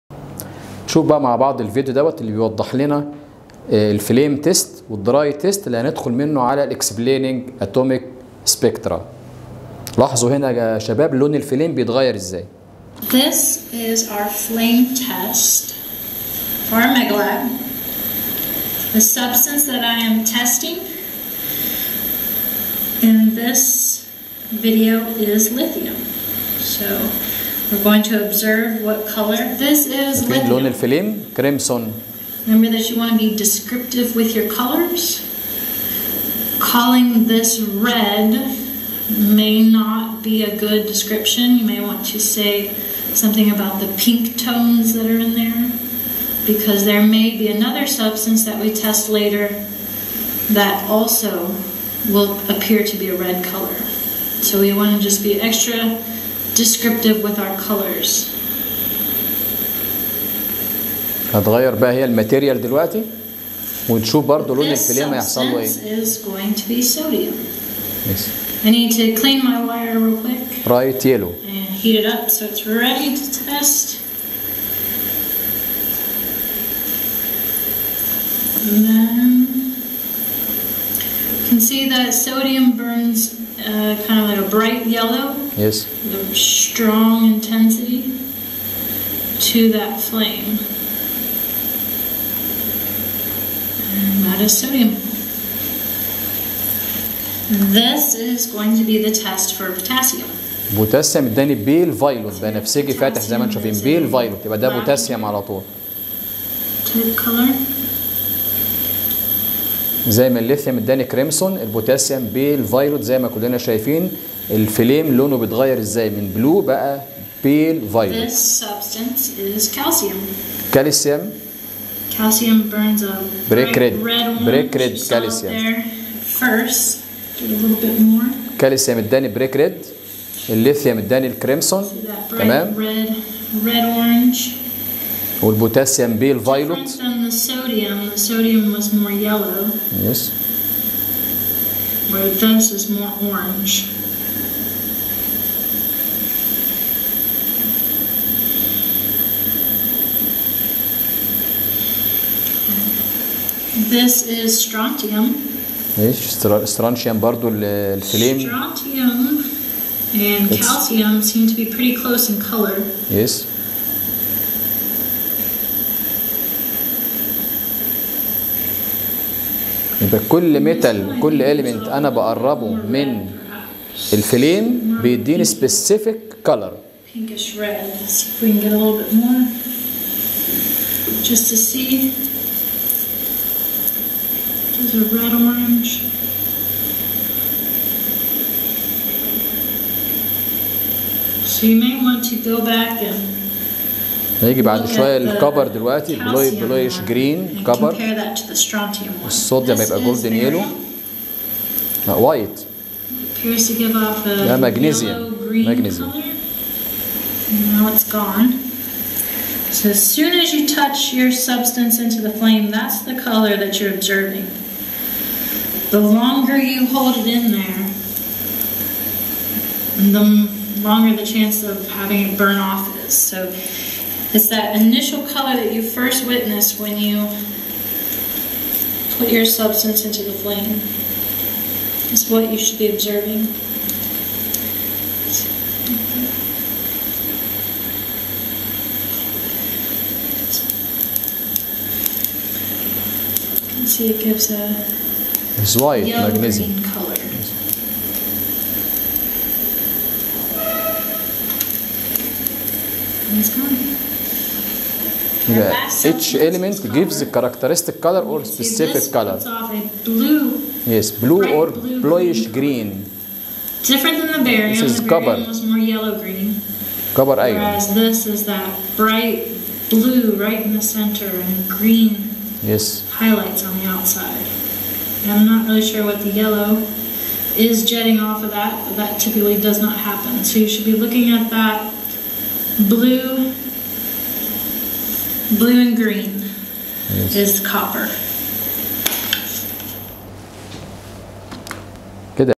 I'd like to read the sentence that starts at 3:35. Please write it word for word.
The longer you hold it in there, the longer the chance of having it burn off is.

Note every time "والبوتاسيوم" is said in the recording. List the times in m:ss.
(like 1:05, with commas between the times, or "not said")
2:15.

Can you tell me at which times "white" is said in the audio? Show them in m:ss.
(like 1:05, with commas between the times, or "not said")
4:05.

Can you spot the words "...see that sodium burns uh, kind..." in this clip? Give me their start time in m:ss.
1:21.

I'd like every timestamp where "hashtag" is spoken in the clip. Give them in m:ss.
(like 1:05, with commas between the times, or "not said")
not said.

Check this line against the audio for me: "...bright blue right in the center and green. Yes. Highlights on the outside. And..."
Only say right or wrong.
right.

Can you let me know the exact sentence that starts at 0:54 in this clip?
So we want to just be extra descriptive with our colors.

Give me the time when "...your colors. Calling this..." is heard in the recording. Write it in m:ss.
0:34.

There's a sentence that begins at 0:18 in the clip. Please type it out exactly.
The substance that I am testing in this video is lithium.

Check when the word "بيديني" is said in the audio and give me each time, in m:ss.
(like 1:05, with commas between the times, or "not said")
2:55.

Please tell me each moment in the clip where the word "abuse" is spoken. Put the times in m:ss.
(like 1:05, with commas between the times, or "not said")
not said.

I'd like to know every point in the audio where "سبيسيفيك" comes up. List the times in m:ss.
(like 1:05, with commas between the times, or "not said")
2:55.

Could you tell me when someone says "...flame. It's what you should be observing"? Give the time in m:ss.
3:50.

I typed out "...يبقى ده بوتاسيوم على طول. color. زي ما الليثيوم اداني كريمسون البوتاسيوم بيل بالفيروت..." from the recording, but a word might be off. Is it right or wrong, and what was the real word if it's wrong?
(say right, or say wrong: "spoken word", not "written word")
right.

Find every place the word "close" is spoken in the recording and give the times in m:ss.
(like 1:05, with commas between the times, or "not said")
2:41.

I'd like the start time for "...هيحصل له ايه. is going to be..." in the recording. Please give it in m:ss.
1:05.